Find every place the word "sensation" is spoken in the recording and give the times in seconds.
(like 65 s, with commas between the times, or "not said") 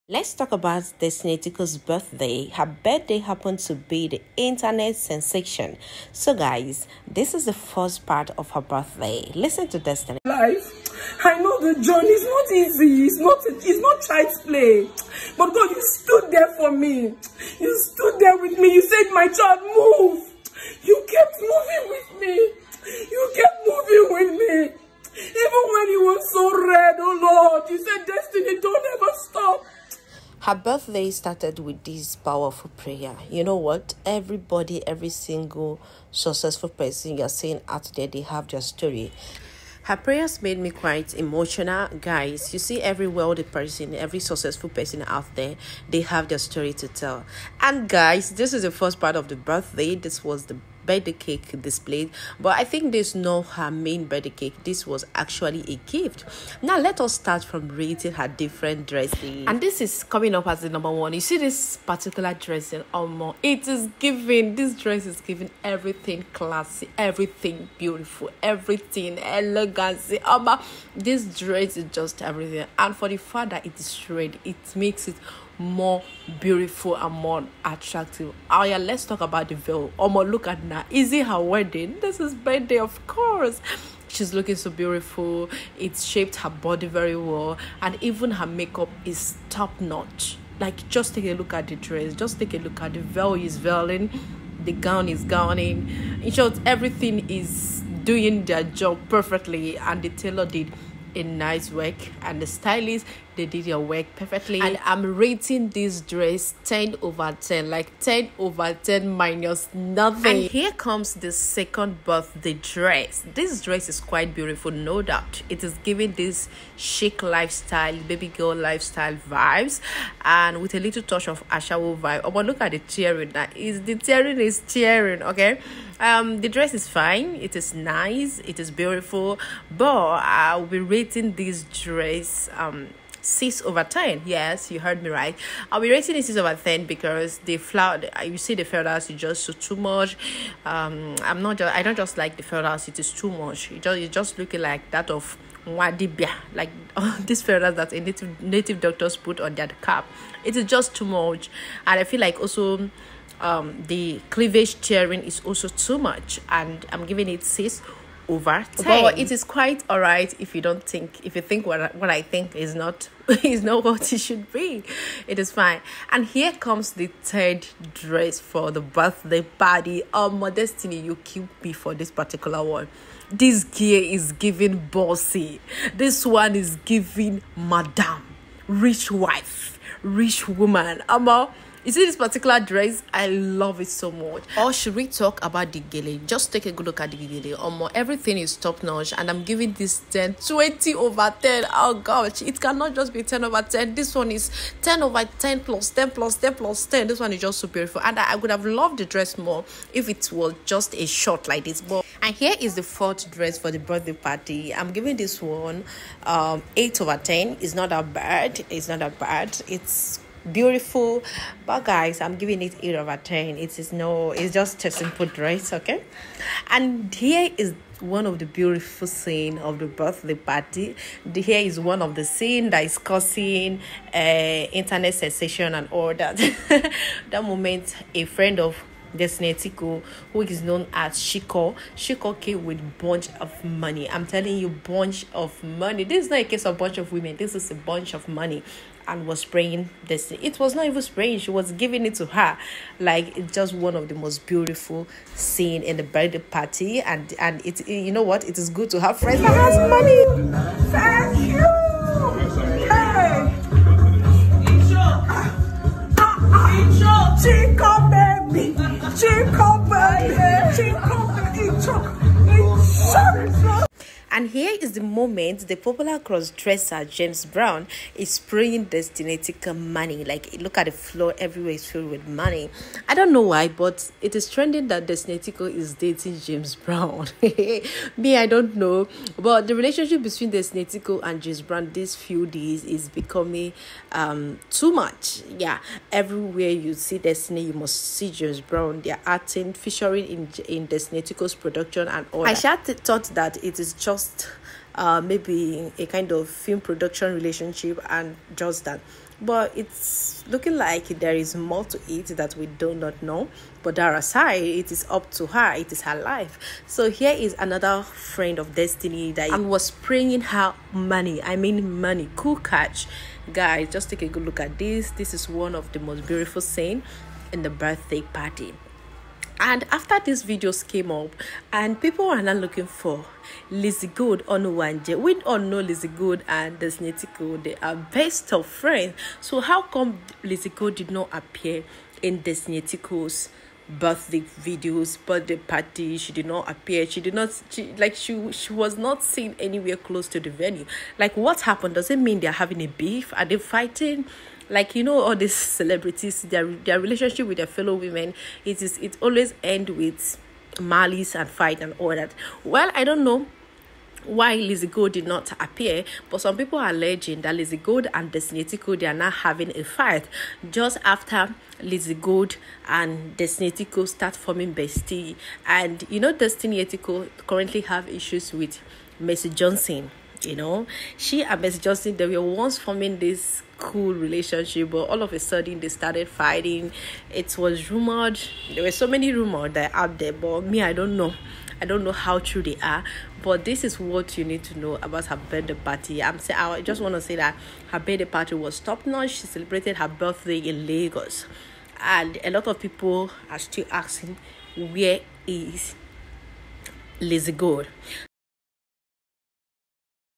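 4 s, 225 s.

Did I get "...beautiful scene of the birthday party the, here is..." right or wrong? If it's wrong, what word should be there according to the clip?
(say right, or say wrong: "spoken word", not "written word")
right.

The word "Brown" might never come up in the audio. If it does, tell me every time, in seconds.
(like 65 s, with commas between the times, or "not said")
267 s, 276 s, 281 s, 288 s.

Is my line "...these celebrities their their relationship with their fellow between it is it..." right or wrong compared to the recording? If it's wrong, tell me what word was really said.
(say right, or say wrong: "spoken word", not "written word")
wrong: "women", not "between".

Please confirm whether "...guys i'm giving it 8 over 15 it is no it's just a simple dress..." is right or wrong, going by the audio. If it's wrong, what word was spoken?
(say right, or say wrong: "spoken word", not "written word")
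wrong: "10", not "15".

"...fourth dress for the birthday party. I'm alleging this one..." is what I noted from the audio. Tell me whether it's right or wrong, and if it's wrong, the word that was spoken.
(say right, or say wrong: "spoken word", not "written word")
wrong: "giving", not "alleging".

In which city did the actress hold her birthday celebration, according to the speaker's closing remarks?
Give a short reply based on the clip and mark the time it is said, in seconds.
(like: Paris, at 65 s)
Lagos, at 390 s.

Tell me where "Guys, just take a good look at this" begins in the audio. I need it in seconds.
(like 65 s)
313 s.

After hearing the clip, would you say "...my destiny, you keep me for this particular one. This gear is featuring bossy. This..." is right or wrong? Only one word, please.
wrong.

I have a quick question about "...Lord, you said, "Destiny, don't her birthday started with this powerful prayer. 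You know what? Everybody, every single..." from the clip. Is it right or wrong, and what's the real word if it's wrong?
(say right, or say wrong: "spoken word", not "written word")
right.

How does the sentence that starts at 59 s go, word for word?
And this is coming up as the number one.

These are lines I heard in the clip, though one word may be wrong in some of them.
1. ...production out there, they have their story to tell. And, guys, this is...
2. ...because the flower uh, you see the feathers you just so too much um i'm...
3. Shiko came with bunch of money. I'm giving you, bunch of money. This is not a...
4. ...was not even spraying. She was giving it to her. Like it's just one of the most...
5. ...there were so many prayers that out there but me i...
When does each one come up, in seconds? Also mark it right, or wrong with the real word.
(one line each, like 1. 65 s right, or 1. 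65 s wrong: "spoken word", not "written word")
1. 44 s wrong: "person", not "production"
2. 136 s right
3. 231 s wrong: "telling", not "giving"
4. 240 s right
5. 378 s wrong: "rumors", not "prayers".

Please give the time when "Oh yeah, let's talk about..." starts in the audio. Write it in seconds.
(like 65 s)
78 s.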